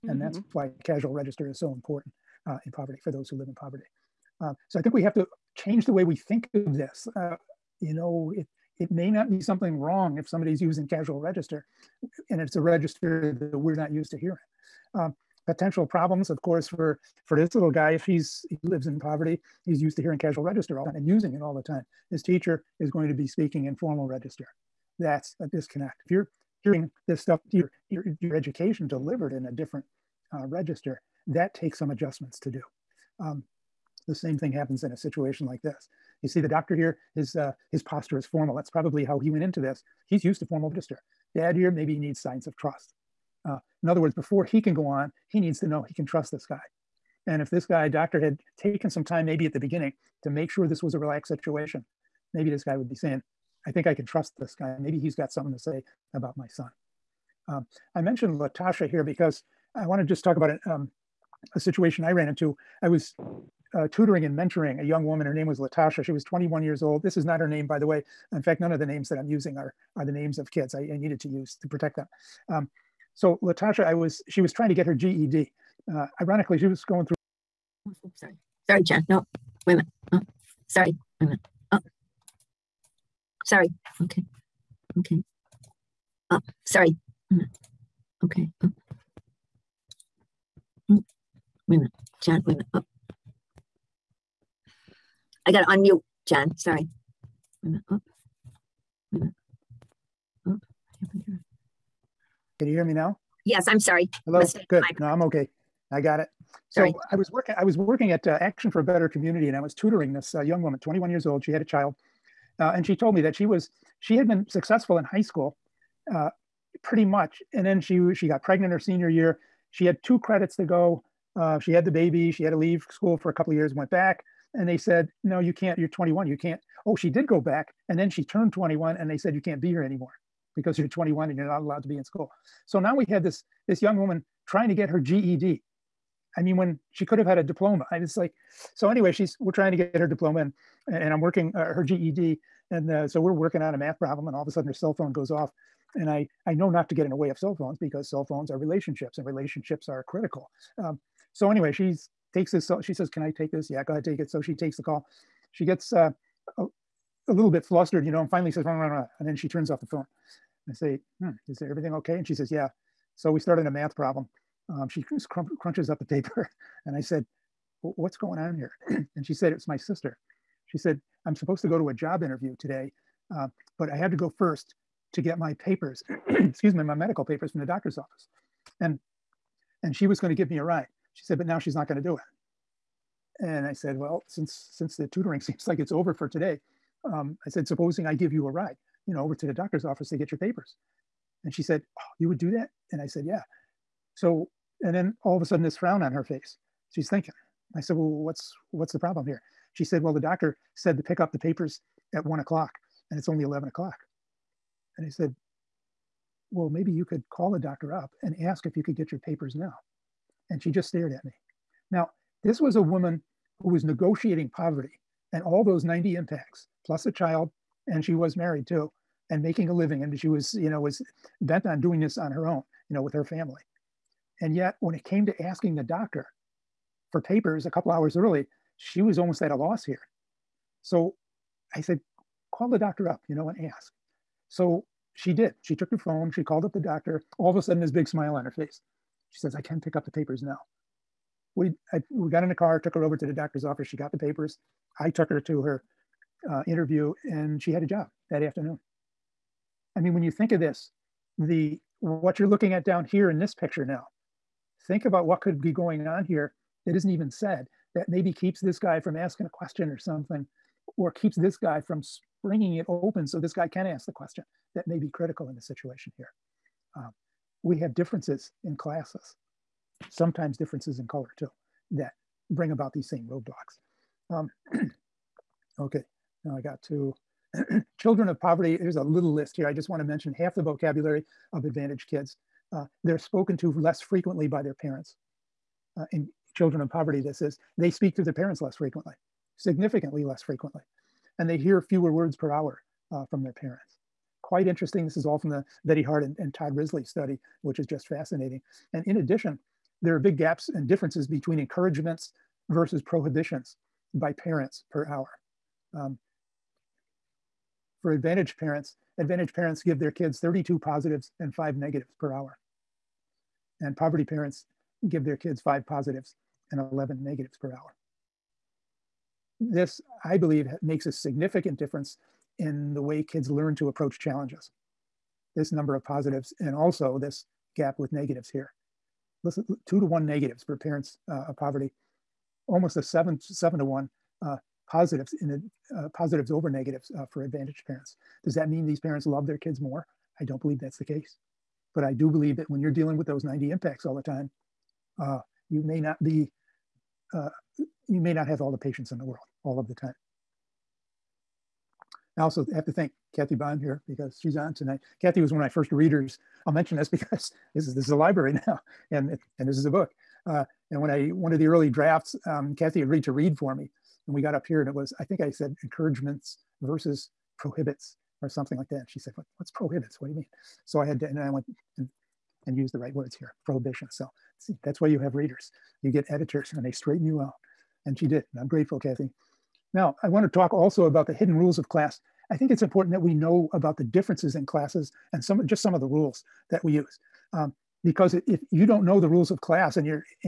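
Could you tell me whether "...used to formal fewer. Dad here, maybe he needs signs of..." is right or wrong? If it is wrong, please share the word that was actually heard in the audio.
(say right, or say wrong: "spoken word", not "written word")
wrong: "register", not "fewer".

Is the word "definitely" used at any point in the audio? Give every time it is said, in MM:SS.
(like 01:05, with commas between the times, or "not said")
not said.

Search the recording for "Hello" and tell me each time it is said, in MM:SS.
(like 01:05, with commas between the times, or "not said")
01:44.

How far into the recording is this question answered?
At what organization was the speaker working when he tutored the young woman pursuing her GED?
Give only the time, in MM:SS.
01:48.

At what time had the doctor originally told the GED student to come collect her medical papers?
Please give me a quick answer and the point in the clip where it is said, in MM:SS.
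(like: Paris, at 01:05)
1 o'clock, at 03:22.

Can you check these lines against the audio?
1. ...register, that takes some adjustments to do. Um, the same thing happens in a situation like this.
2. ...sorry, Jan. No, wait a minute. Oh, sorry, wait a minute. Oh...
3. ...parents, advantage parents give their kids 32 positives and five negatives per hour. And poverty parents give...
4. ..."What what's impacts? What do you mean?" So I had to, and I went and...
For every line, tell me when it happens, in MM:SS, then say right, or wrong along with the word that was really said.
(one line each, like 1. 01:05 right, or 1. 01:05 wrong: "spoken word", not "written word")
1. 00:30 right
2. 01:18 right
3. 05:08 right
4. 06:09 wrong: "prohibits", not "impacts".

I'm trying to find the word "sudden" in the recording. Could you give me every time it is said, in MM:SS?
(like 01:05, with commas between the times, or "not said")
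02:24, 03:15, 03:57.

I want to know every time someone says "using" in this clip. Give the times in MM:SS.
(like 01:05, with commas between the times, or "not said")
00:10, 00:21, 01:09.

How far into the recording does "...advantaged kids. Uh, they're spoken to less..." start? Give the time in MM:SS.
04:41.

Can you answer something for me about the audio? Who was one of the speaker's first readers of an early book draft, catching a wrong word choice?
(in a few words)
Kathy Bond.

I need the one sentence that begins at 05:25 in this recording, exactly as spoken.
This number of positives and also this gap with negatives here.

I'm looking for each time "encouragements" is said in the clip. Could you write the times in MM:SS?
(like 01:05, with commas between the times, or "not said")
05:01, 06:05.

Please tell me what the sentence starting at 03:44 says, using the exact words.
And yet, when it came to asking the doctor for papers a couple hours early, she was almost at a loss here.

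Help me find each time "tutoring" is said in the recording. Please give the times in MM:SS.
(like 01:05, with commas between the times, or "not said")
01:03, 01:49, 03:05.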